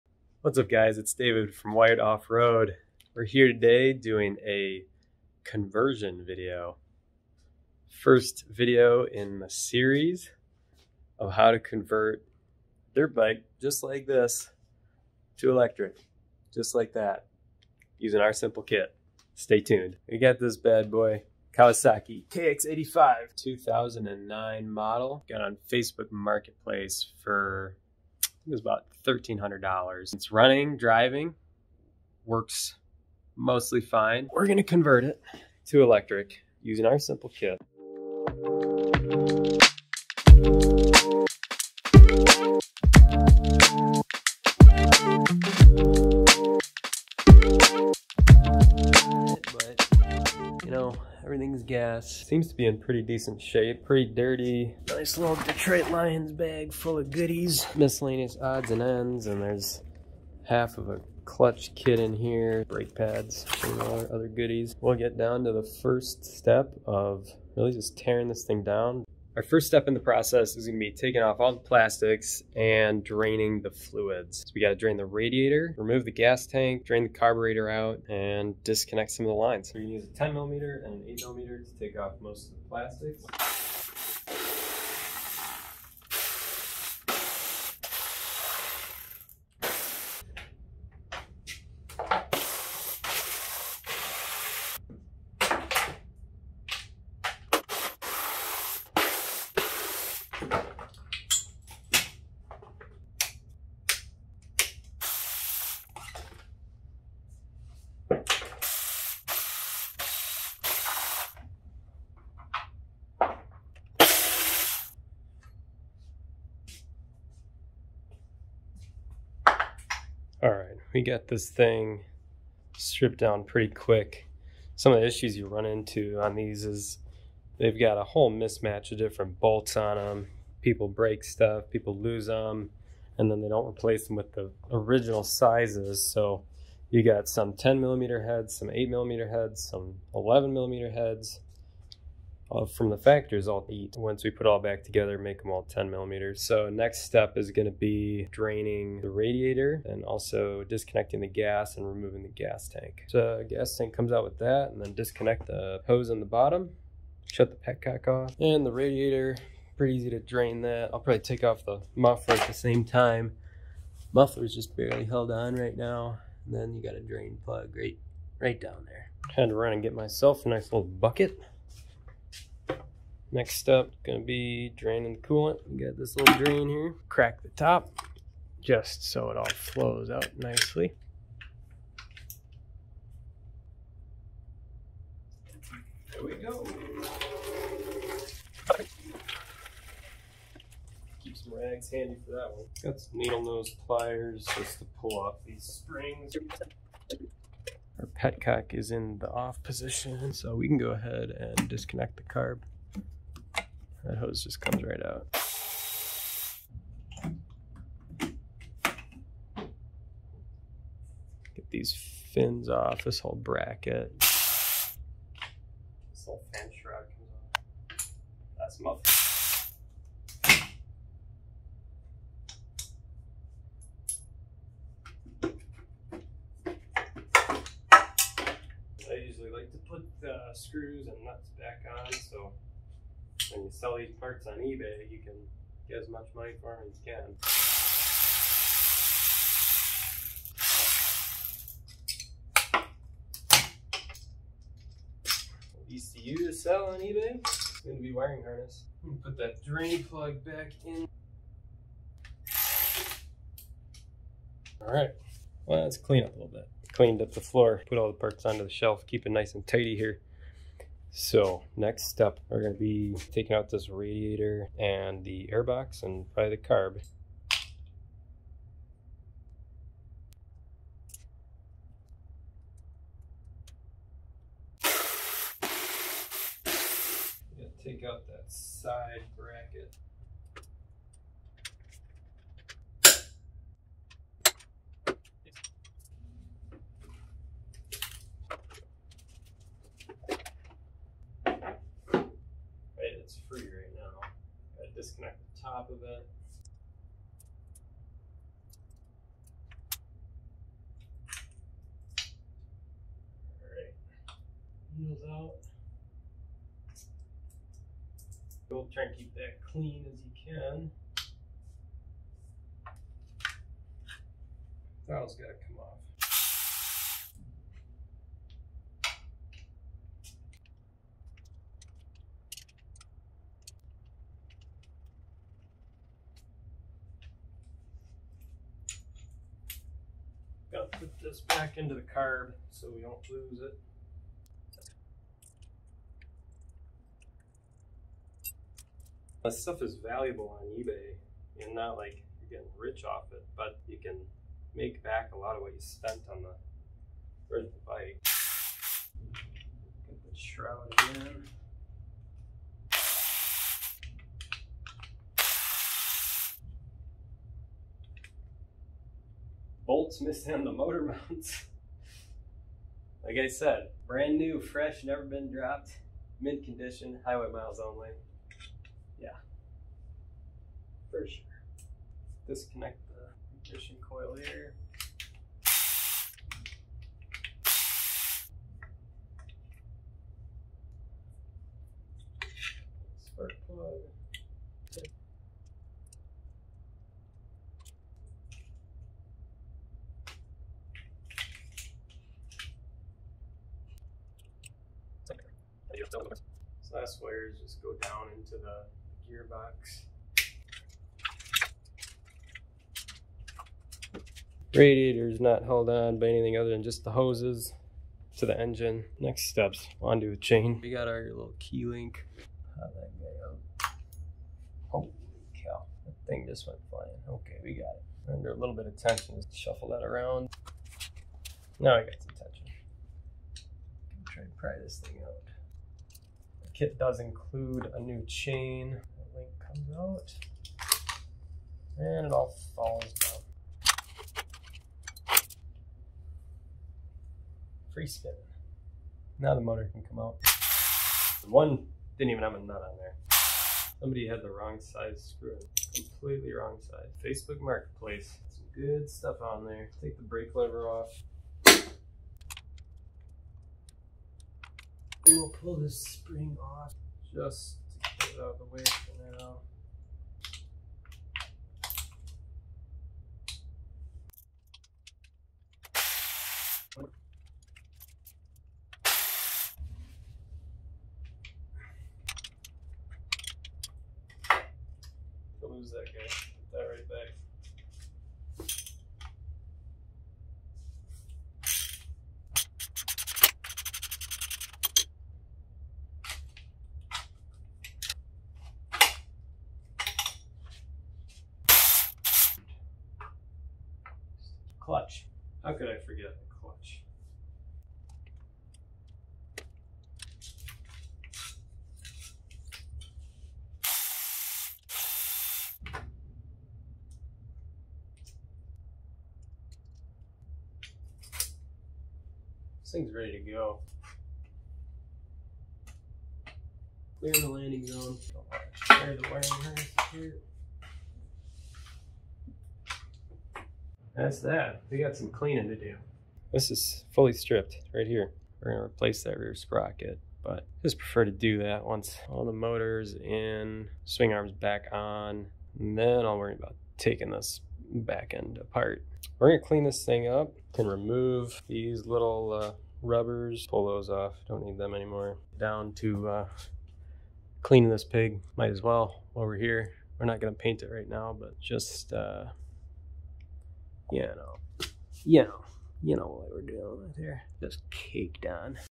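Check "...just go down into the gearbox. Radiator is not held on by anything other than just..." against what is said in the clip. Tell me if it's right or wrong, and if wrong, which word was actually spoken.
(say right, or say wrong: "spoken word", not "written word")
right.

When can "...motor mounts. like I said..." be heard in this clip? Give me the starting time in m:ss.
6:00.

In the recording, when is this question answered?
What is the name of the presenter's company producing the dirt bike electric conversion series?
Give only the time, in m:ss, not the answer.
0:01.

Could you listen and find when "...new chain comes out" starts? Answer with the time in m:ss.
7:07.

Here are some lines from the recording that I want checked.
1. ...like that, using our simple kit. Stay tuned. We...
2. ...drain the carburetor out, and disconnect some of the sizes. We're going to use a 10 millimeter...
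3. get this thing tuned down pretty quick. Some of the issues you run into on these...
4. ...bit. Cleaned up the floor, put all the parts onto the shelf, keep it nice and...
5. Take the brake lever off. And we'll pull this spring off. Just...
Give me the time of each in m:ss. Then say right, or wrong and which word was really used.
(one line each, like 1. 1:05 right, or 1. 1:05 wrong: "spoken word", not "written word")
1. 0:16 right
2. 1:16 wrong: "lines", not "sizes"
3. 2:01 wrong: "stripped", not "tuned"
4. 4:16 right
5. 7:30 right.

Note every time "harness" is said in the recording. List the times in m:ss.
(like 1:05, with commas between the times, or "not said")
4:08, 8:39.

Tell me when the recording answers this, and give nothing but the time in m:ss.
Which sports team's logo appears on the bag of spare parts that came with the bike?
0:55.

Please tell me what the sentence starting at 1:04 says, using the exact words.
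We'll get down to the first step of really just tearing this thing down.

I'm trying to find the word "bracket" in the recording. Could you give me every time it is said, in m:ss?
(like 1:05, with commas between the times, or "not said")
3:33, 4:39.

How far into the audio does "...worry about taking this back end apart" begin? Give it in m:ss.
8:56.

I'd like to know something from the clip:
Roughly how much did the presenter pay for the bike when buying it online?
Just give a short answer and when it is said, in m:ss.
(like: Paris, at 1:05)
$1,300, at 0:29.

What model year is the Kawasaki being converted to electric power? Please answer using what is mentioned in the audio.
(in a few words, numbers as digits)
2009.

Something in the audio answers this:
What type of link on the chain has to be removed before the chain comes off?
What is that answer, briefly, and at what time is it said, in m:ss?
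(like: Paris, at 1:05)
key link, at 6:51.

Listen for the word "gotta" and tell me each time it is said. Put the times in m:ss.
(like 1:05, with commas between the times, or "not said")
5:15, 5:30.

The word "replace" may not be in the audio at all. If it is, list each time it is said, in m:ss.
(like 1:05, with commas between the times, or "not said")
2:13, 8:48.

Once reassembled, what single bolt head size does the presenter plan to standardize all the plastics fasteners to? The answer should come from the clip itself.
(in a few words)
10 millimeters.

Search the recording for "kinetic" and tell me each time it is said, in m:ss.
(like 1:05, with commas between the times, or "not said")
not said.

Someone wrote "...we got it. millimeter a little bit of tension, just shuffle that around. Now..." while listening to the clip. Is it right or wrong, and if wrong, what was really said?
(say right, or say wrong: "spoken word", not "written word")
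wrong: "under", not "millimeter".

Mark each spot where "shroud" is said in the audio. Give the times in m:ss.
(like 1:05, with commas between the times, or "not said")
3:36, 5:50.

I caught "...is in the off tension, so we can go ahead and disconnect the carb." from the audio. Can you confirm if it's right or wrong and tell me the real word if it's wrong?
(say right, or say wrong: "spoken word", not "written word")
wrong: "position", not "tension".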